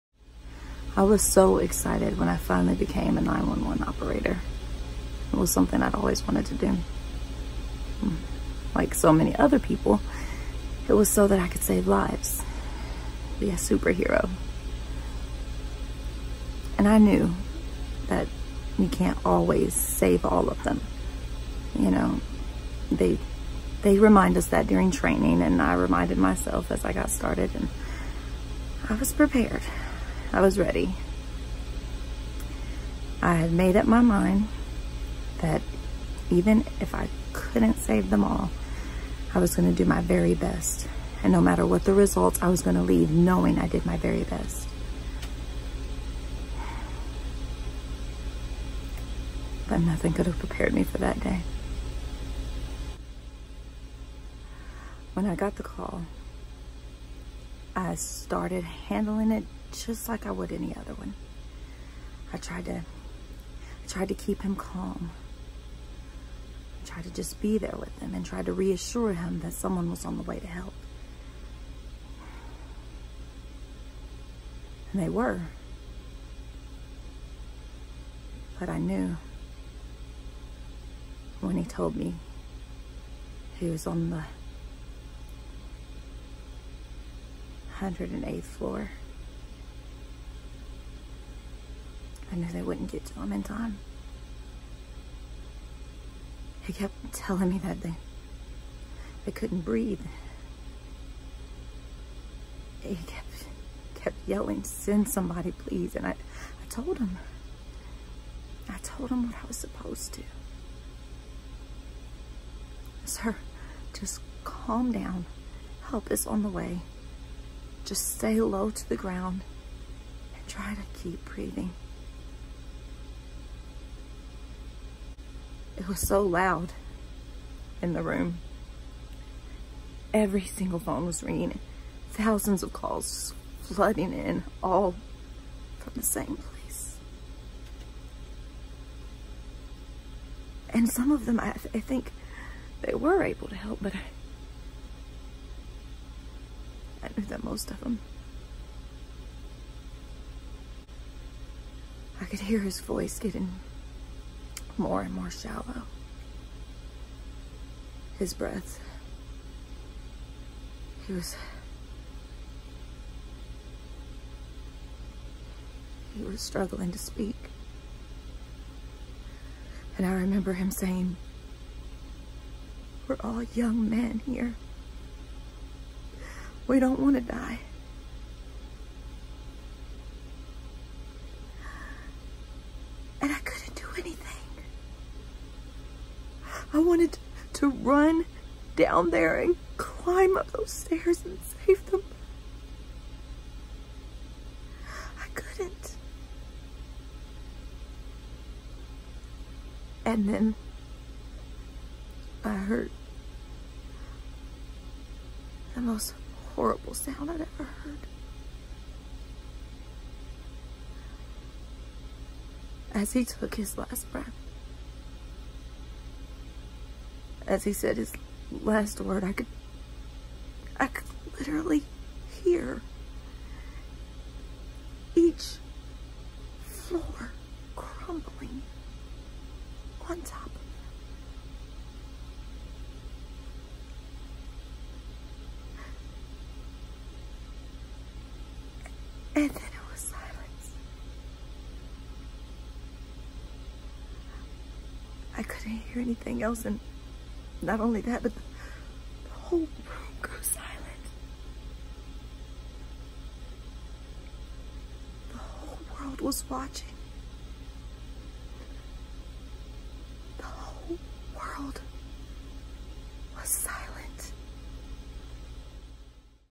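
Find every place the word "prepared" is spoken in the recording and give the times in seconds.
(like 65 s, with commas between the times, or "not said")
29 s, 50 s.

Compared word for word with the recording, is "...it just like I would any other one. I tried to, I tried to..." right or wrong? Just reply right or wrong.
right.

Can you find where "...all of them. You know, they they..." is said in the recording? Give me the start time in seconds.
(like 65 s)
20 s.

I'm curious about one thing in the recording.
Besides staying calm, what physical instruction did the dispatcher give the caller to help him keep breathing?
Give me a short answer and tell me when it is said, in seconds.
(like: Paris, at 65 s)
Stay low to the ground, at 118 s.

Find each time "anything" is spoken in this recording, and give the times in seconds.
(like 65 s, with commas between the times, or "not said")
183 s, 246 s.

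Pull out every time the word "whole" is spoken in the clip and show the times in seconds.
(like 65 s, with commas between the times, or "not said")
249 s, 255 s, 260 s.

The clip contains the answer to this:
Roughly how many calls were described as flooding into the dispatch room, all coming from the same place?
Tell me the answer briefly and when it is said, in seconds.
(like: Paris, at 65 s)
Thousands, at 132 s.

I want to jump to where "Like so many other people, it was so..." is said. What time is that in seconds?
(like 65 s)
8 s.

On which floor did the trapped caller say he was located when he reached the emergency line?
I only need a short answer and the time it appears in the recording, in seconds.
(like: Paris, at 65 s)
108th floor, at 87 s.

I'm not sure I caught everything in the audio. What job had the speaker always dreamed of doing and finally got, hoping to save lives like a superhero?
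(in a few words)
911 operator.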